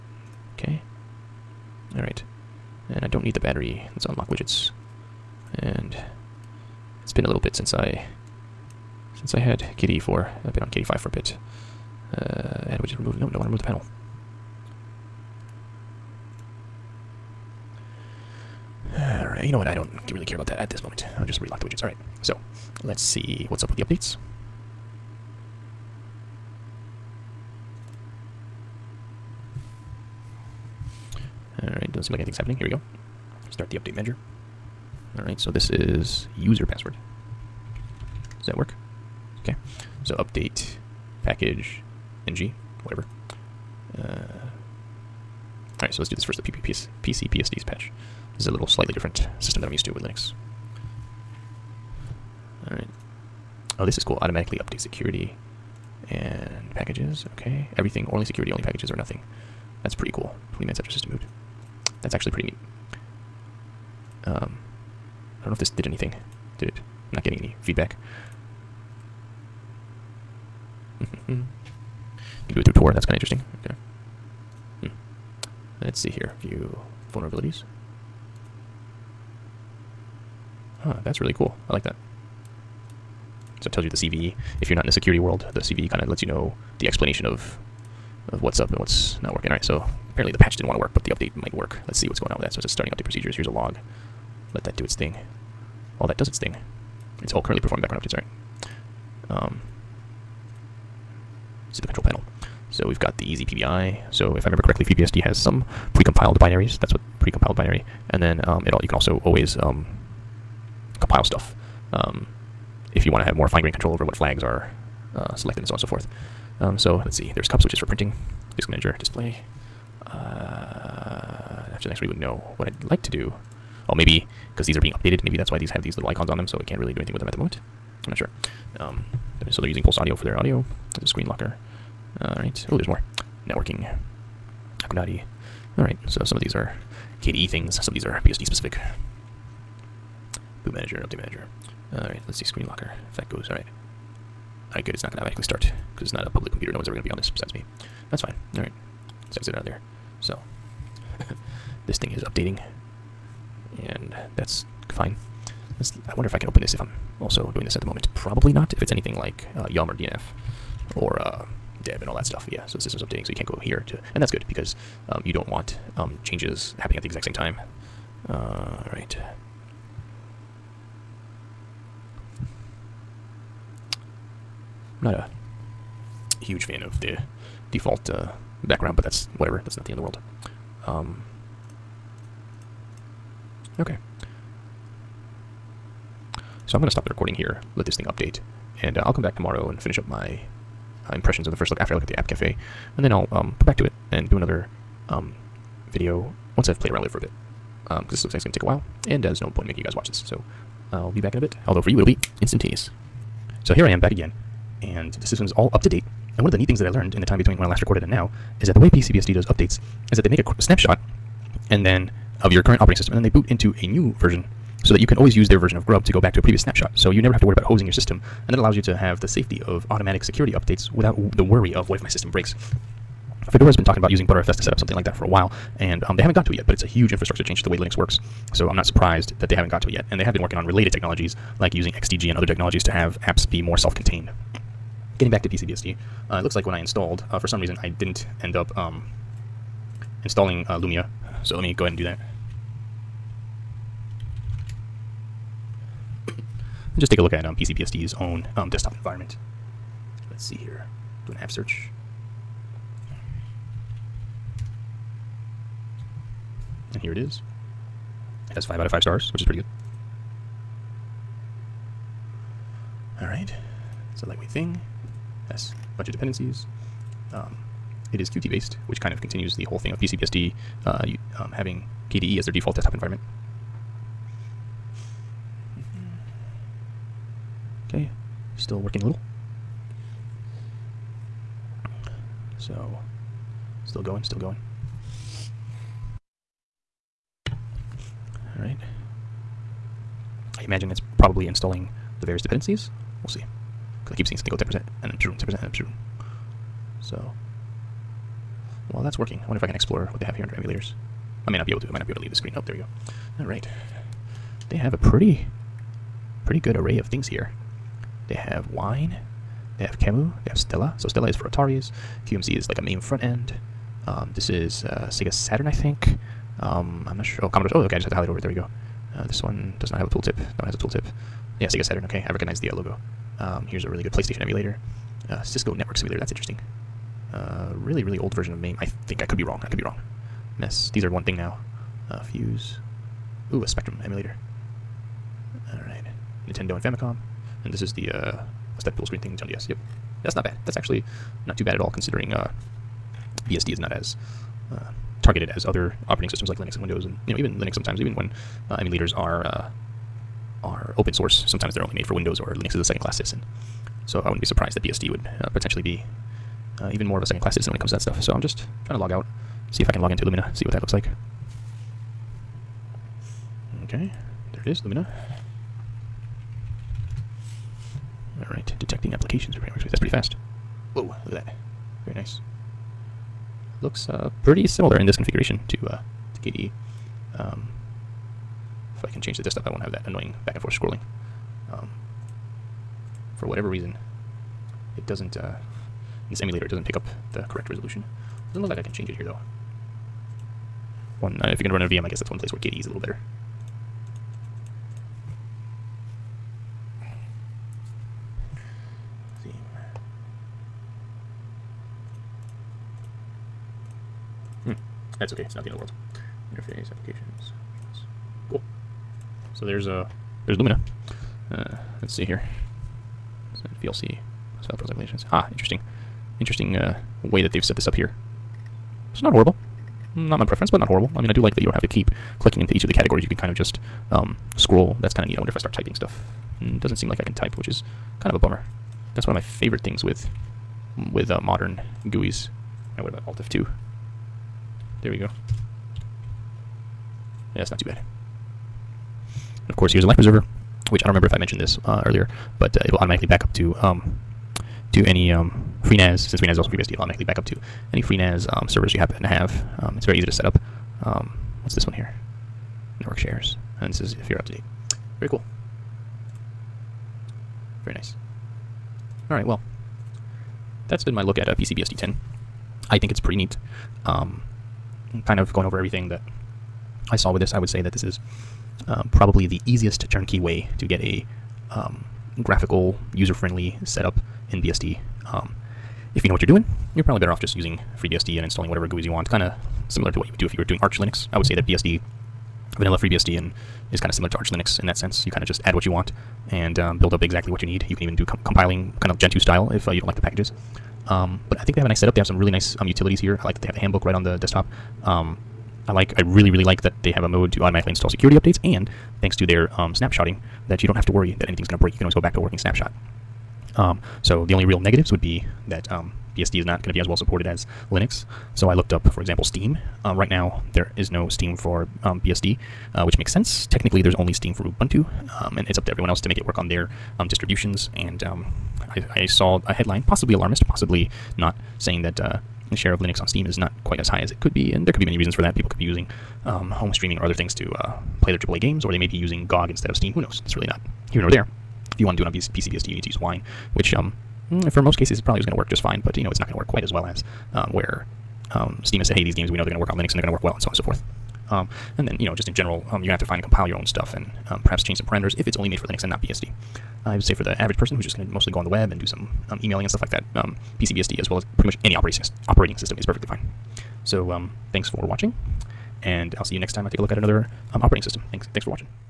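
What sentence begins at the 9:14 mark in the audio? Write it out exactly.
So um, thanks for watching, and I'll see you next time I take a look at another um, operating system.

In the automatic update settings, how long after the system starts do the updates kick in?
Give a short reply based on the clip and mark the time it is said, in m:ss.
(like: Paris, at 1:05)
20 minutes, at 1:00.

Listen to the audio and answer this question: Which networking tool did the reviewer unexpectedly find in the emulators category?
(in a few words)
Cisco Network Simulator.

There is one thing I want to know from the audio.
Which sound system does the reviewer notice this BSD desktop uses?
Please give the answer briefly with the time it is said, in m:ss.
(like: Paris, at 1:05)
Pulse Audio, at 2:09.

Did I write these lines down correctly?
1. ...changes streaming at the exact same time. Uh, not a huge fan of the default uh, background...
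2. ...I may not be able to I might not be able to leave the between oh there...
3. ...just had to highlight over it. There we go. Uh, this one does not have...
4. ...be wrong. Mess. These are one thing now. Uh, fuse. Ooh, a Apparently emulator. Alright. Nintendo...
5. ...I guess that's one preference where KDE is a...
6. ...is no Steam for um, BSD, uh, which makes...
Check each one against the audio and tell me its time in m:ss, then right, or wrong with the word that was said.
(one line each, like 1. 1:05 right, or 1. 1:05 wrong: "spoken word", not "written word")
1. 2:46 wrong: "happening", not "streaming"
2. 5:01 wrong: "screen", not "between"
3. 5:17 right
4. 5:29 wrong: "Spectrum", not "Apparently"
5. 6:32 wrong: "place", not "preference"
6. 8:30 right.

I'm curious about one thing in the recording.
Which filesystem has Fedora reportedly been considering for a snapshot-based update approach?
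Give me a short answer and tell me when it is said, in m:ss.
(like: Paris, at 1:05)
ButterFS, at 3:44.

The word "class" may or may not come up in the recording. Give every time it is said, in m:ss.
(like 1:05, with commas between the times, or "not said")
5:52, 5:57.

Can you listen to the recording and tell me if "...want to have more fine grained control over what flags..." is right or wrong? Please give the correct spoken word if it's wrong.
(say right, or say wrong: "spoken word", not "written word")
right.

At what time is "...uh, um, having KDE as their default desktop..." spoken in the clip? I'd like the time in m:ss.
4:30.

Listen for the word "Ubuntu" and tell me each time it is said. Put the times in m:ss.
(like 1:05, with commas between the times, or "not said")
8:34.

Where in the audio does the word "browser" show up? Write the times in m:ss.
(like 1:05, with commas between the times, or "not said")
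6:54.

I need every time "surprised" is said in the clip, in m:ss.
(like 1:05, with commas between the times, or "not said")
3:48, 5:54.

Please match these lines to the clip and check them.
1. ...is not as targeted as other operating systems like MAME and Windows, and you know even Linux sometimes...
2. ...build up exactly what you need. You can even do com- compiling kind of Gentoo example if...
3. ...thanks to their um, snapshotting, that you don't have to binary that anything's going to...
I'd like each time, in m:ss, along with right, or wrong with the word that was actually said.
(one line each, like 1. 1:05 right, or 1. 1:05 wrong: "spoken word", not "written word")
1. 5:43 wrong: "Linux", not "MAME"
2. 8:06 wrong: "style", not "example"
3. 8:19 wrong: "worry", not "binary".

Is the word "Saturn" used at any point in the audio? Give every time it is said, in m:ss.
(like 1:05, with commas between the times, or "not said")
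5:15, 5:21.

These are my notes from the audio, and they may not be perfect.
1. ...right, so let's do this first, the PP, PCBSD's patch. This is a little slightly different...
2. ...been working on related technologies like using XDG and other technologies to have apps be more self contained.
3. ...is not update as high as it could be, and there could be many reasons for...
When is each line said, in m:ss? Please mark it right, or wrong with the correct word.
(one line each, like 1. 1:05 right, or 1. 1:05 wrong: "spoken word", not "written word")
1. 0:45 right
2. 3:50 right
3. 8:43 wrong: "quite", not "update".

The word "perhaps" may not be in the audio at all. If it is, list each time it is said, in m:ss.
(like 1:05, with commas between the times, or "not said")
9:04.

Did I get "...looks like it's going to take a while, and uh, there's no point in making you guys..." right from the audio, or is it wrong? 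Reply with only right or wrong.
right.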